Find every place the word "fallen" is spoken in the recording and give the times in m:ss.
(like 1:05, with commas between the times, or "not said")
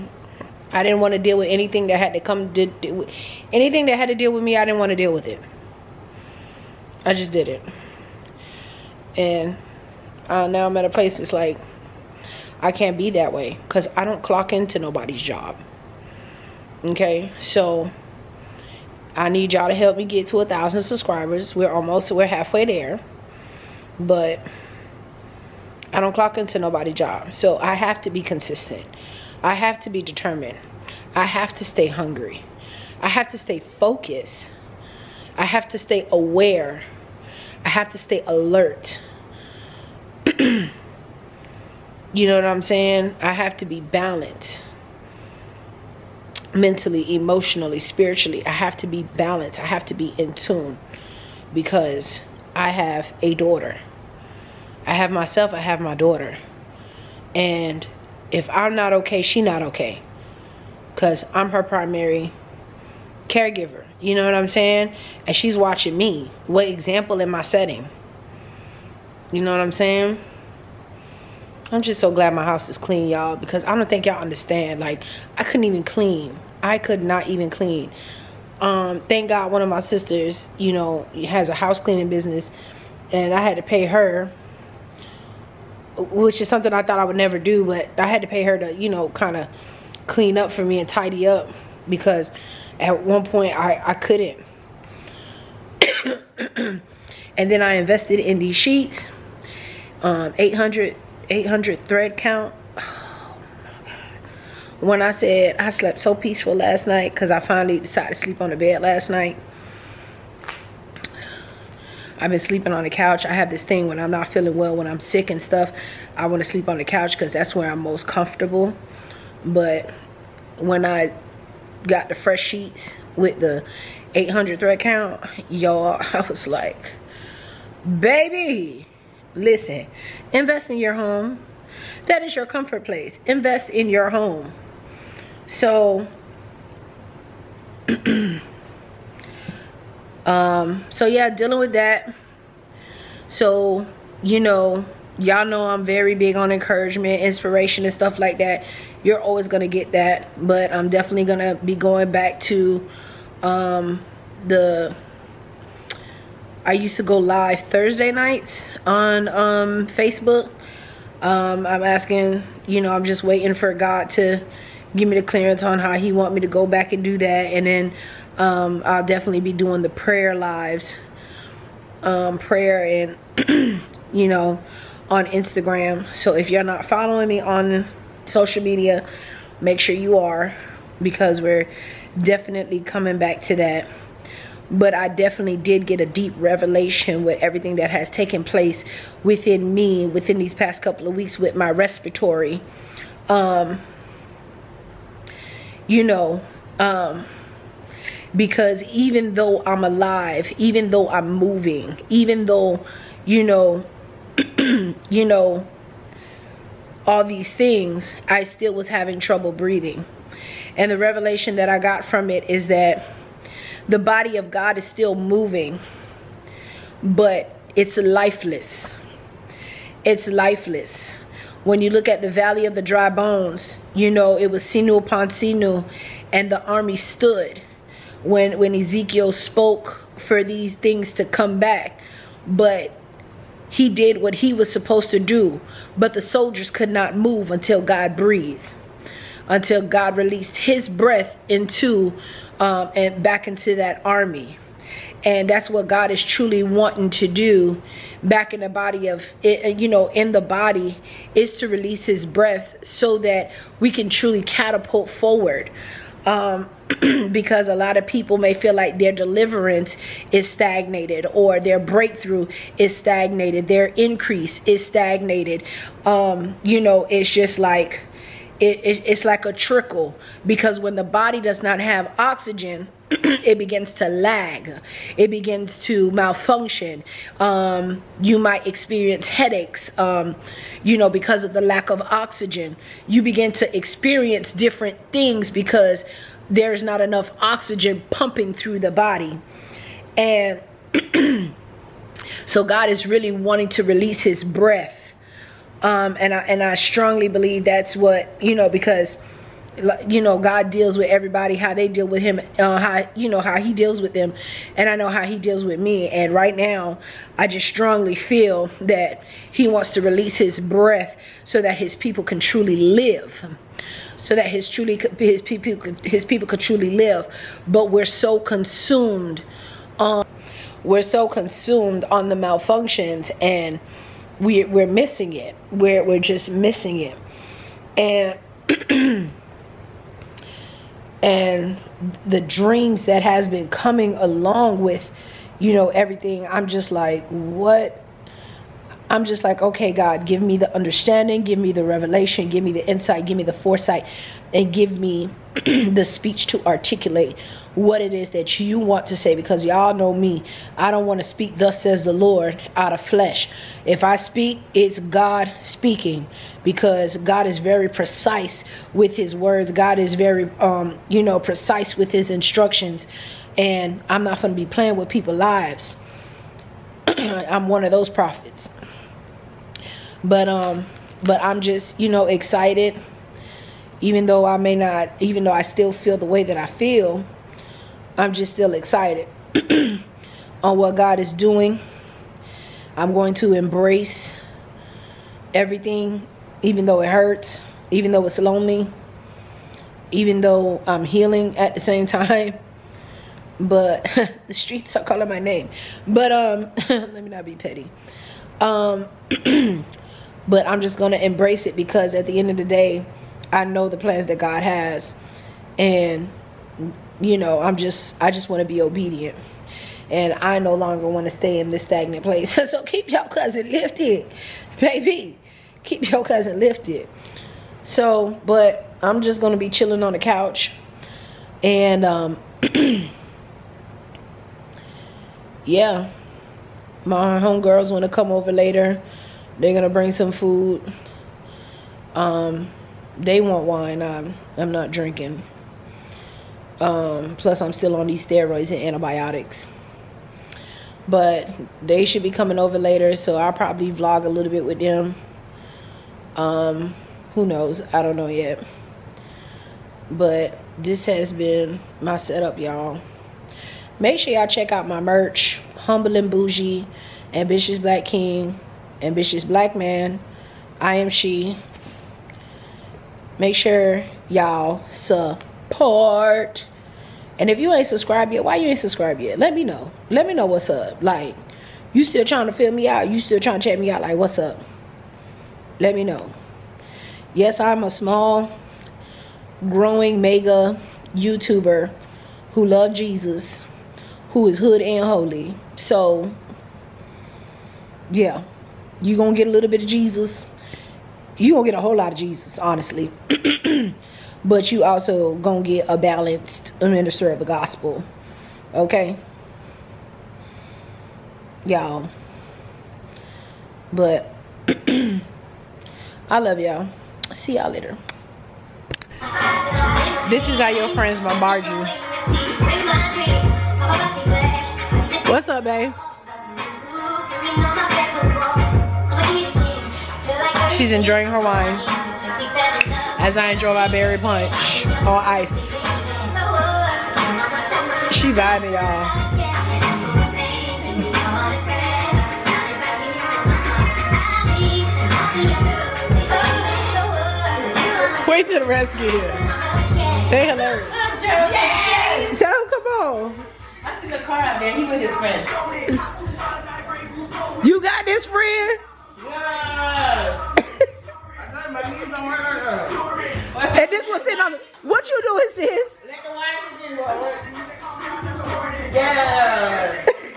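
not said.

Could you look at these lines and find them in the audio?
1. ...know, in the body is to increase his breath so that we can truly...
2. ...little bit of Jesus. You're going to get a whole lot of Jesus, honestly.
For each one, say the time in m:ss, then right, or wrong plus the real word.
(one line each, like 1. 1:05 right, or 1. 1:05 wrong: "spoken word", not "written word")
1. 4:09 wrong: "release", not "increase"
2. 8:09 right.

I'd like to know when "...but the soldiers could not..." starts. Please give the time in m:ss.
3:55.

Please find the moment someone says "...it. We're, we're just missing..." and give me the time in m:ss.
5:25.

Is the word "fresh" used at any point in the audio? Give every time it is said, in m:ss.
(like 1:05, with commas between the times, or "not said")
2:02.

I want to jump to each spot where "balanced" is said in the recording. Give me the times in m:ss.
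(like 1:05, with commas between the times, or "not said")
0:43, 0:49, 8:15.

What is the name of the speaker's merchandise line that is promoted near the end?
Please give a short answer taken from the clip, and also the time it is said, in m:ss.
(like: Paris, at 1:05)
Humble and Bougie, at 7:35.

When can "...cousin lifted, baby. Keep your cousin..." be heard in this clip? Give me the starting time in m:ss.
6:53.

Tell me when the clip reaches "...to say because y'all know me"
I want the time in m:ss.
5:49.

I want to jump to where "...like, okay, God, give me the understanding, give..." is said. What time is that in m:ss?
5:39.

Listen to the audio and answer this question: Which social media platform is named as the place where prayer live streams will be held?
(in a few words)
Instagram.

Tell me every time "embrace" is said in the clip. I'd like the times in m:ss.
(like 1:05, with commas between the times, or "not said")
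6:23, 6:41.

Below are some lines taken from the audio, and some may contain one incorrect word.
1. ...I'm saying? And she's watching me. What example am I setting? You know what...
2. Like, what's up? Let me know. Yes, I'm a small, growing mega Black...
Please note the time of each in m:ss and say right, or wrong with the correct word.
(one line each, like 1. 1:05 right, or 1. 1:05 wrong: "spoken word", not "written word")
1. 1:04 right
2. 7:54 wrong: "YouTuber", not "Black".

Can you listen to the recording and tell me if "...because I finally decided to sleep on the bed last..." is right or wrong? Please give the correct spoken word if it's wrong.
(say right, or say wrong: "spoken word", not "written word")
right.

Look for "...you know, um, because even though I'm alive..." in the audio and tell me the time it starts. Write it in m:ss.
3:15.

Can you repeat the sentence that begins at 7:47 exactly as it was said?
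And if you ain't subscribed yet, why you ain't subscribed yet?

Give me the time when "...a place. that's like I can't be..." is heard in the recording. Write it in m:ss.
0:10.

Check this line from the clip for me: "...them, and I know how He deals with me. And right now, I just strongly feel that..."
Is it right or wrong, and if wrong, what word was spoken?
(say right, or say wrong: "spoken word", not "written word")
right.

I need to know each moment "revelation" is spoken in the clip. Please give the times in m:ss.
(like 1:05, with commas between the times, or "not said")
3:06, 3:30, 5:41.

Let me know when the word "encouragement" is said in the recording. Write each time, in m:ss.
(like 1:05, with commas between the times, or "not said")
2:26.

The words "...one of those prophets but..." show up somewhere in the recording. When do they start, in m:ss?
6:07.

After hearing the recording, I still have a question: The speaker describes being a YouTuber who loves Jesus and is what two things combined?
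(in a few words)
hood and holy.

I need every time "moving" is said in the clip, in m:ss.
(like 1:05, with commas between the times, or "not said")
3:21, 3:35.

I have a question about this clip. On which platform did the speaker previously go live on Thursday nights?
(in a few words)
Facebook.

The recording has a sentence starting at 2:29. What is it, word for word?
You're always going to get that.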